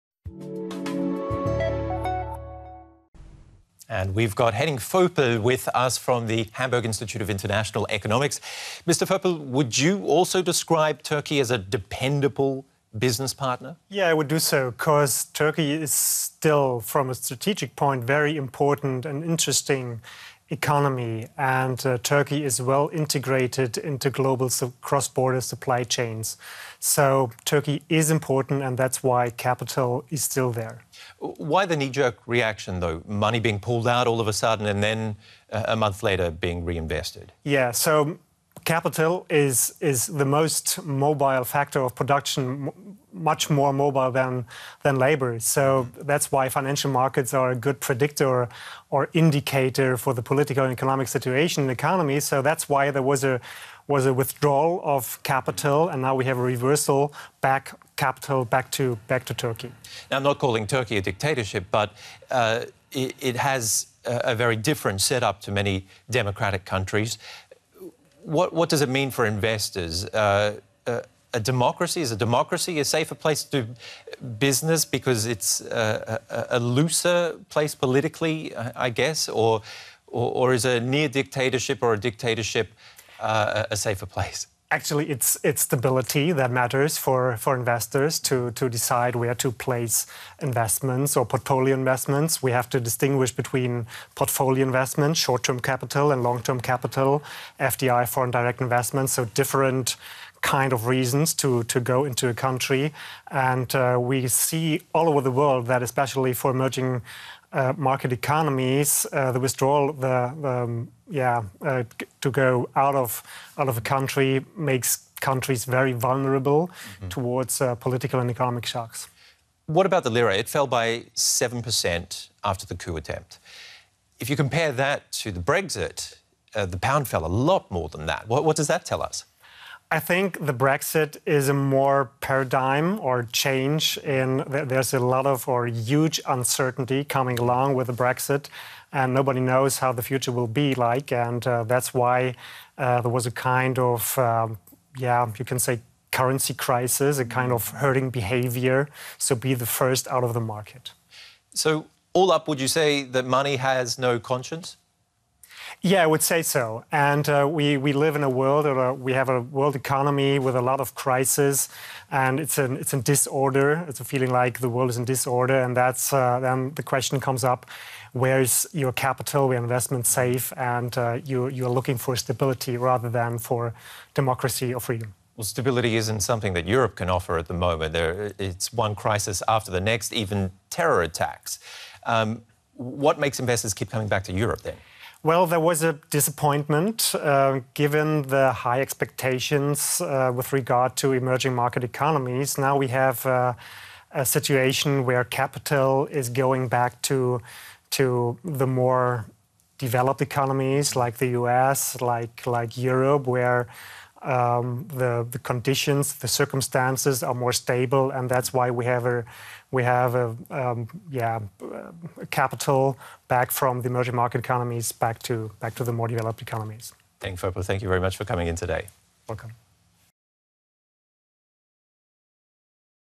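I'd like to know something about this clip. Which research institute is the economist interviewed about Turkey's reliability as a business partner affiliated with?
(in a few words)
Hamburg Institute of International Economics.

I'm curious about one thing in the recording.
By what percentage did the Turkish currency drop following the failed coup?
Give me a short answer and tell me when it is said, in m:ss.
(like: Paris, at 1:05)
7%, at 2:01.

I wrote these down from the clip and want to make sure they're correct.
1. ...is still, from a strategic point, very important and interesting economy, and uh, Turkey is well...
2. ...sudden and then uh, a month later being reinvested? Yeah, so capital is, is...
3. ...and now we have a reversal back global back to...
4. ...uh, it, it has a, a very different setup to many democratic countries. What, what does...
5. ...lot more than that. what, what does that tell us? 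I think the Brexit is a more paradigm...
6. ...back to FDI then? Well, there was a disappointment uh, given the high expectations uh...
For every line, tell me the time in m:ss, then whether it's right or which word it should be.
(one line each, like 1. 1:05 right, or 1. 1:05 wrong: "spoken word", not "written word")
1. 0:15 right
2. 0:34 right
3. 0:55 wrong: "capital", not "global"
4. 1:02 right
5. 2:07 right
6. 3:04 wrong: "Europe", not "FDI".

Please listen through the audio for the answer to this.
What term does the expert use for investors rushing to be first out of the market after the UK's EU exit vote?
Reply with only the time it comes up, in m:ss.
2:27.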